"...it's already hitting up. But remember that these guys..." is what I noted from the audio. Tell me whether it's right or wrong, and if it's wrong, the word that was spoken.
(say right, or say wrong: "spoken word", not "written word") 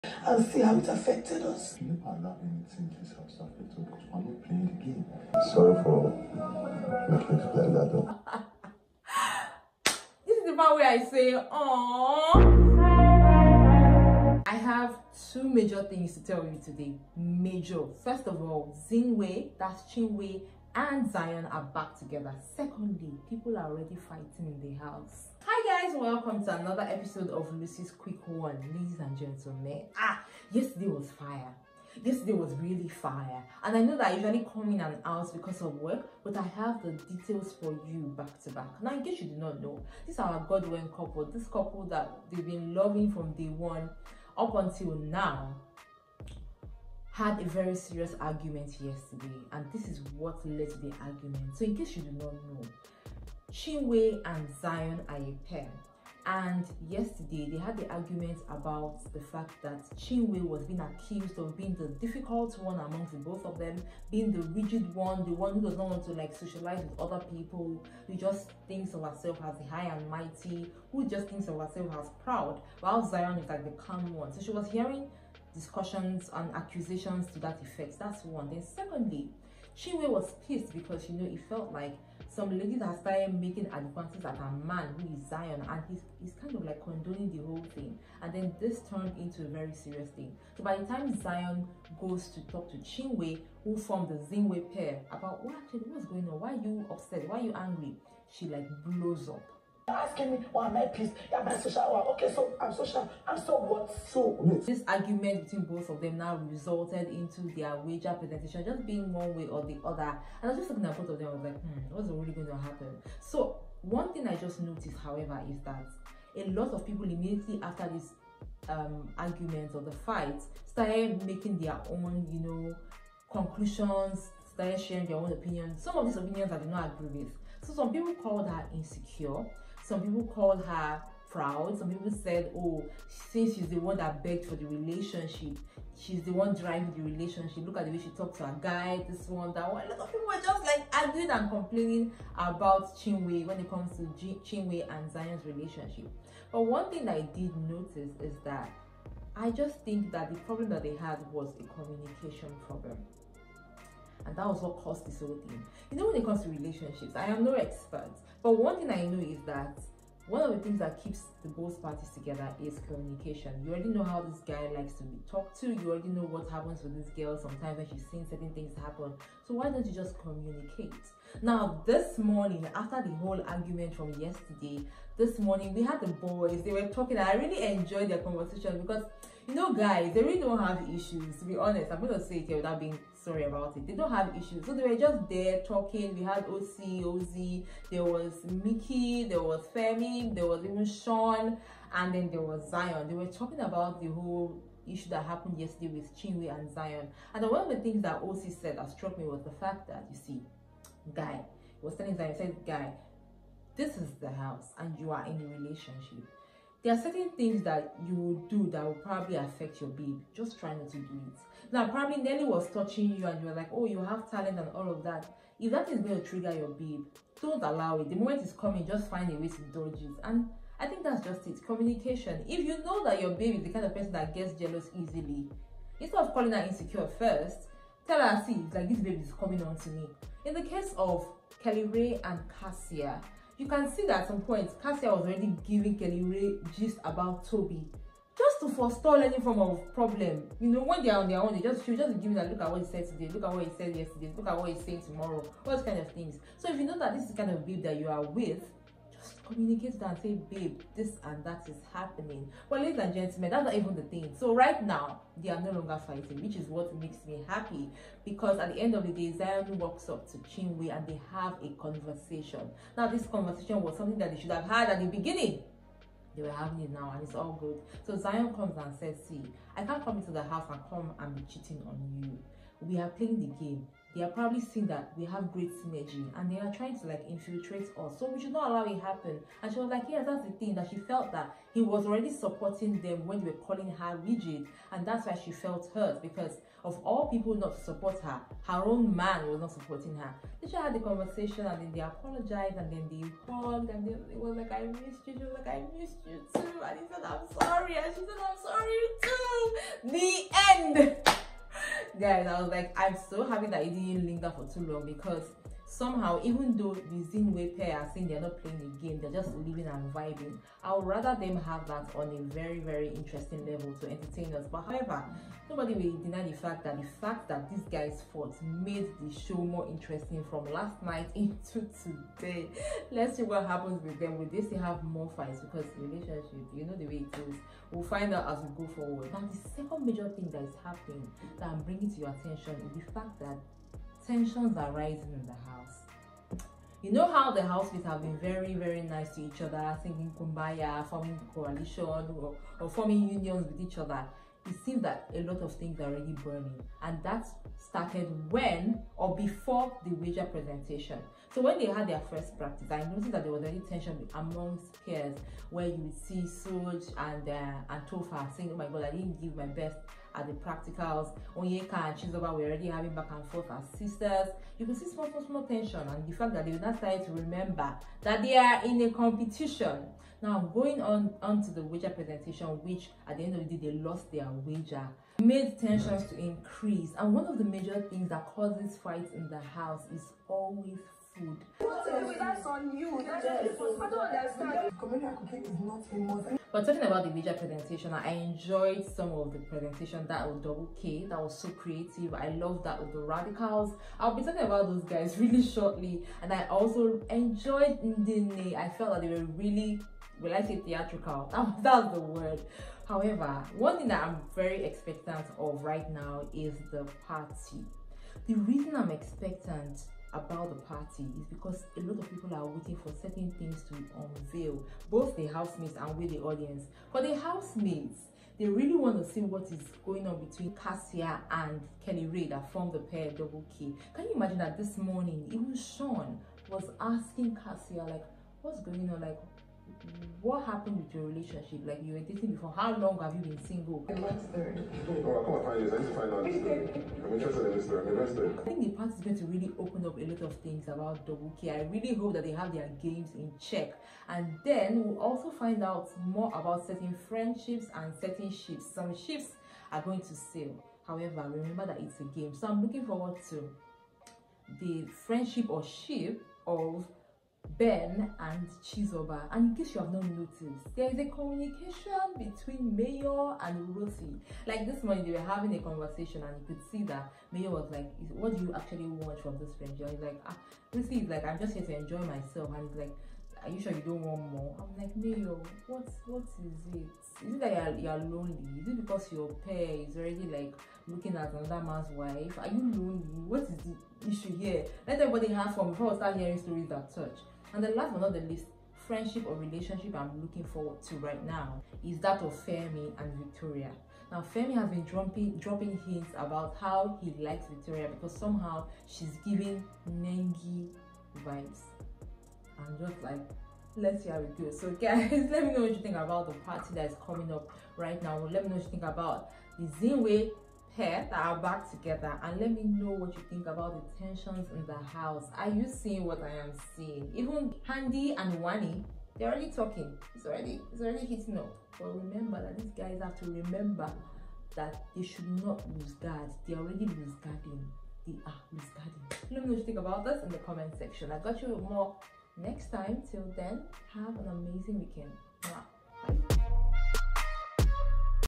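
right.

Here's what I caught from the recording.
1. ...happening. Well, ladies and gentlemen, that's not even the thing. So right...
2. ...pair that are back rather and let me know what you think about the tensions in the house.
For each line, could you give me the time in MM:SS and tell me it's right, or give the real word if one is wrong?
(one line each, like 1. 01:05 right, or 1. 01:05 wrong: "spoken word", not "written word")
1. 04:11 right
2. 08:30 wrong: "together", not "rather".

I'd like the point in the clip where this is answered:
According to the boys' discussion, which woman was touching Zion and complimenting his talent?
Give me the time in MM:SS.
03:32.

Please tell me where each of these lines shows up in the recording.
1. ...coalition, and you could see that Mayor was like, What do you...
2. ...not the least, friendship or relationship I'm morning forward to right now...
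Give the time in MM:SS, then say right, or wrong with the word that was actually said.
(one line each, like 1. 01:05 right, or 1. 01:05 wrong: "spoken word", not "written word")
1. 07:45 wrong: "conversation", not "coalition"
2. 08:08 wrong: "looking", not "morning".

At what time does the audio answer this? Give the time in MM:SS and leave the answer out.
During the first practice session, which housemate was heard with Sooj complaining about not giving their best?
05:58.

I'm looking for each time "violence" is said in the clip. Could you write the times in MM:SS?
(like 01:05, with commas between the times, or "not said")
not said.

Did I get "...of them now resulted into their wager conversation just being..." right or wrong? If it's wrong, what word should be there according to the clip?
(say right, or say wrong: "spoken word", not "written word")
wrong: "presentation", not "conversation".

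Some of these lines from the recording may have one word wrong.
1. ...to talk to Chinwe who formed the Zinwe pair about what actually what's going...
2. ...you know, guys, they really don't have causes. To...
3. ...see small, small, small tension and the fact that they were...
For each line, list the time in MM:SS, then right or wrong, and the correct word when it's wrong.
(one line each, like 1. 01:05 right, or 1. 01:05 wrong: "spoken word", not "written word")
1. 01:32 right
2. 02:59 wrong: "issues", not "causes"
3. 06:04 right.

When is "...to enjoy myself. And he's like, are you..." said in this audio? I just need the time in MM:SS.
07:51.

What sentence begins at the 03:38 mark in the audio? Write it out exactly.
The moment is coming, just find a way to dodge it.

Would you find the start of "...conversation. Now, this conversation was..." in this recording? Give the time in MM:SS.
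04:21.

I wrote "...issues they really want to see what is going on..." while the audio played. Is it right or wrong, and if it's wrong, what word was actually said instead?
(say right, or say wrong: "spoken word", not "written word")
wrong: "housemates", not "issues".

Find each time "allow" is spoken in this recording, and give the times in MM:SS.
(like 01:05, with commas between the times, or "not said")
00:02, 03:37, 04:38.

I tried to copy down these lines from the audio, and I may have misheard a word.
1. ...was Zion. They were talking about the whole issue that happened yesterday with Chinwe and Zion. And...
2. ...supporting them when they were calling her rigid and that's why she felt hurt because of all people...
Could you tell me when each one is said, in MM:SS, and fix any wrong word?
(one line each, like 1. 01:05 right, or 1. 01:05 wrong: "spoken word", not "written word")
1. 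03:12 right
2. 04:42 right.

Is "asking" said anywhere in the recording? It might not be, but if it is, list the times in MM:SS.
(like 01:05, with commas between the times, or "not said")
01:39, 07:06.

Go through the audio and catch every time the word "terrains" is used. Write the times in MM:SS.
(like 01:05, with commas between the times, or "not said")
not said.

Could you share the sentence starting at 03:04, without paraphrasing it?
So they were just there talking.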